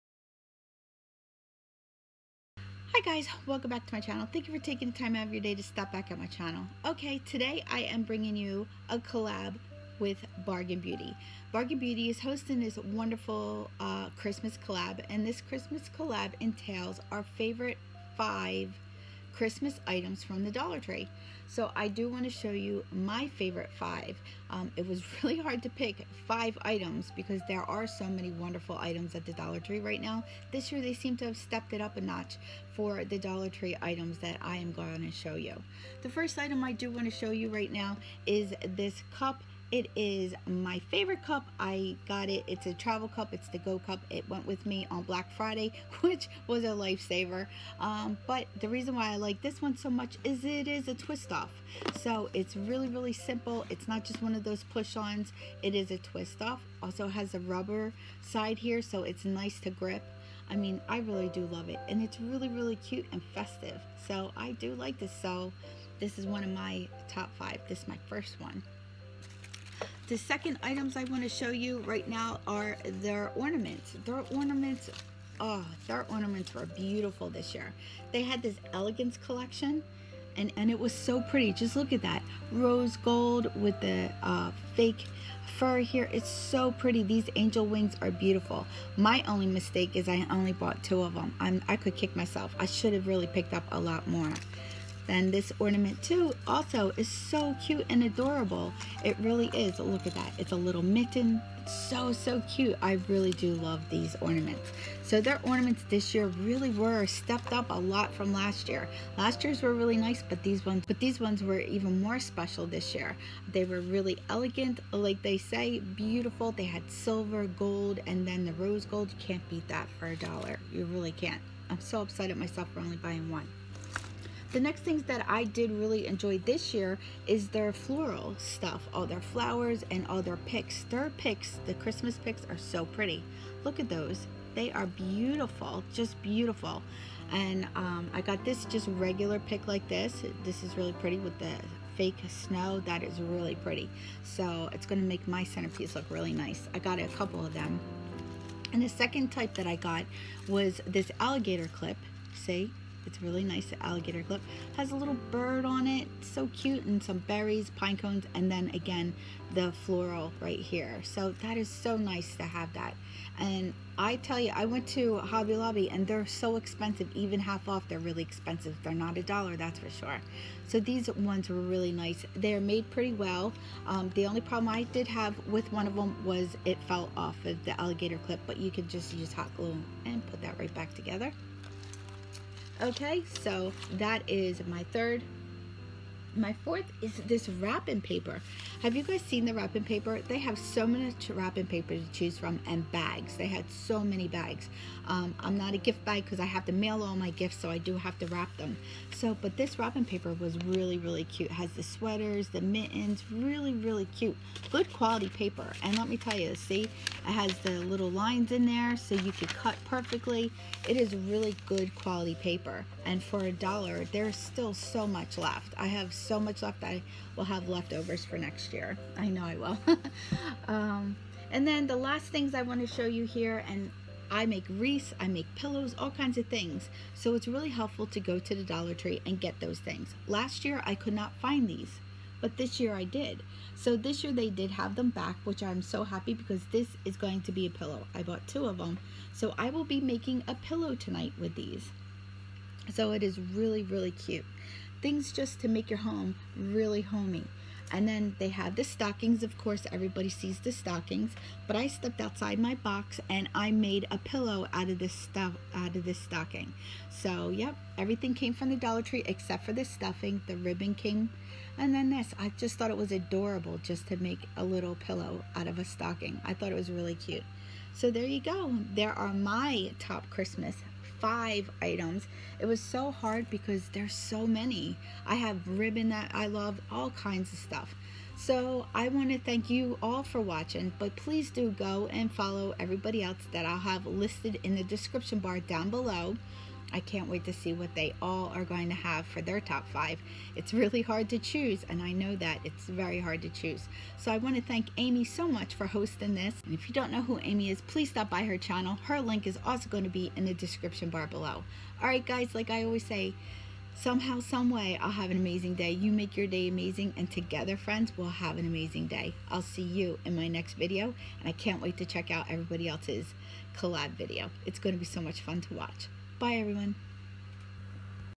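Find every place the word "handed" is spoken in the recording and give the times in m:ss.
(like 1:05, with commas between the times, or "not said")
not said.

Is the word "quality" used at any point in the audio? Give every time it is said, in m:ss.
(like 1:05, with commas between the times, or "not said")
3:24, 3:31.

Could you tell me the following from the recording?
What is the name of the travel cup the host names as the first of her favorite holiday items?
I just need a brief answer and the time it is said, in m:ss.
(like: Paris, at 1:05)
Go Cup, at 0:43.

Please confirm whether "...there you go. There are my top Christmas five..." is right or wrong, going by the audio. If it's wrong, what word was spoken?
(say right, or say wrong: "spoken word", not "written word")
right.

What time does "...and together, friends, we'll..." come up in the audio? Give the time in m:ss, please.
5:07.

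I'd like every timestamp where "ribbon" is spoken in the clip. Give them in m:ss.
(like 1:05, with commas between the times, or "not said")
4:20, 4:35.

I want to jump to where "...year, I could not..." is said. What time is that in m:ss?
3:50.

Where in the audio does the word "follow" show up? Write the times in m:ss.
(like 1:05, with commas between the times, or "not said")
4:42.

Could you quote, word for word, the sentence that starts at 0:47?
Um, but the reason why I like this one so much is it is a twist off.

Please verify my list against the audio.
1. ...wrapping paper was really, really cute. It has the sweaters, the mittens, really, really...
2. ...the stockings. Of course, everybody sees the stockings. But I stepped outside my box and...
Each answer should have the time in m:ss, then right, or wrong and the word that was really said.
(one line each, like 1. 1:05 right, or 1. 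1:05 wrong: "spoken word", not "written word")
1. 3:19 right
2. 4:08 right.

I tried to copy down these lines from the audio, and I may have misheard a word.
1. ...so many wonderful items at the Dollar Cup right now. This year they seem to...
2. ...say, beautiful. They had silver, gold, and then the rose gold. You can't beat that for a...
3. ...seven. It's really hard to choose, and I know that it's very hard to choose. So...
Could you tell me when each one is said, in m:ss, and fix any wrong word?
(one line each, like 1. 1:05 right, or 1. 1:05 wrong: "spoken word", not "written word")
1. 0:27 wrong: "Tree", not "Cup"
2. 1:55 right
3. 4:49 wrong: "five", not "seven".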